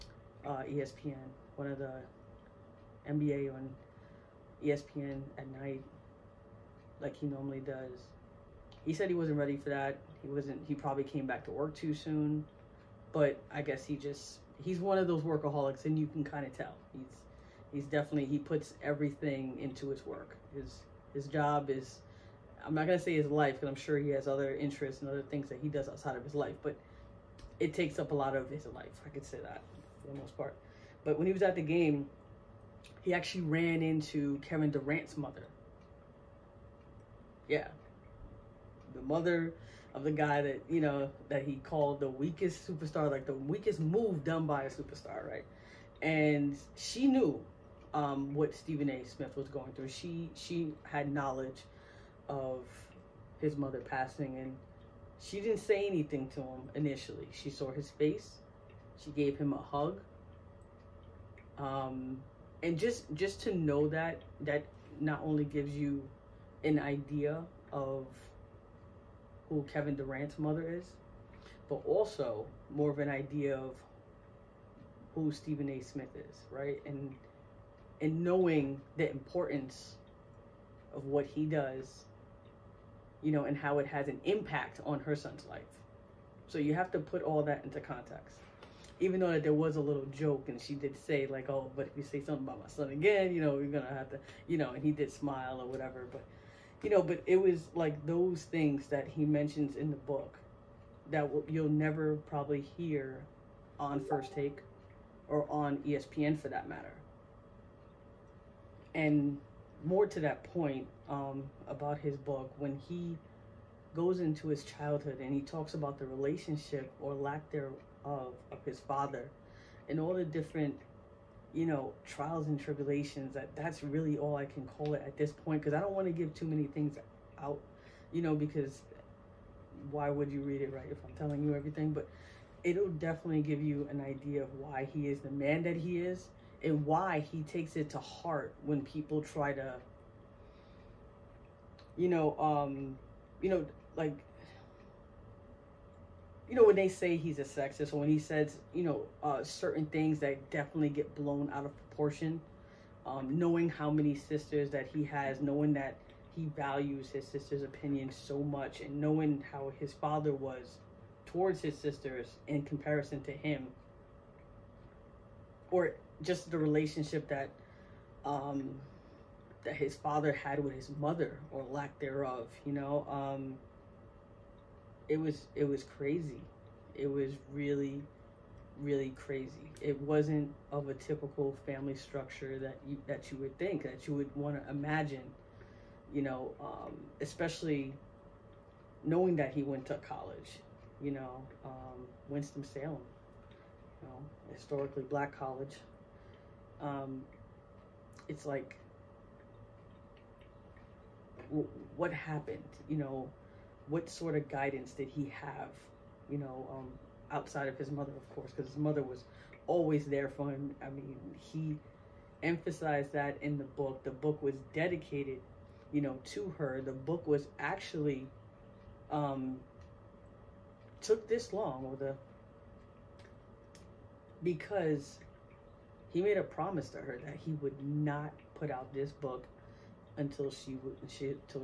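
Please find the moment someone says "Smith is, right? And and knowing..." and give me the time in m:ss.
1:15.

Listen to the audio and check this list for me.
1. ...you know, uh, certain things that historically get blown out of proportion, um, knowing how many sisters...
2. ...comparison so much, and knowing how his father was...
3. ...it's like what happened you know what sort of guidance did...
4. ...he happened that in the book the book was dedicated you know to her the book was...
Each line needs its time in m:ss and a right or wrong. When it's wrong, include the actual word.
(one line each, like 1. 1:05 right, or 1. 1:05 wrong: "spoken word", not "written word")
1. 2:28 wrong: "definitely", not "historically"
2. 2:37 wrong: "opinion", not "comparison"
3. 3:18 right
4. 3:31 wrong: "emphasized", not "happened".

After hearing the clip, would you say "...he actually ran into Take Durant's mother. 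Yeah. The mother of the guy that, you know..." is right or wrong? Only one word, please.
wrong.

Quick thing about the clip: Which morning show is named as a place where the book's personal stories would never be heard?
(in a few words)
First Take.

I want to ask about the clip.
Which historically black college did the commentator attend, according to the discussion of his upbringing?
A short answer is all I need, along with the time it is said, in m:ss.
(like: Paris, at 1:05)
Winston-Salem, at 3:12.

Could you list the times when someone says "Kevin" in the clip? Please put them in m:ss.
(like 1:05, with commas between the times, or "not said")
0:34, 1:09.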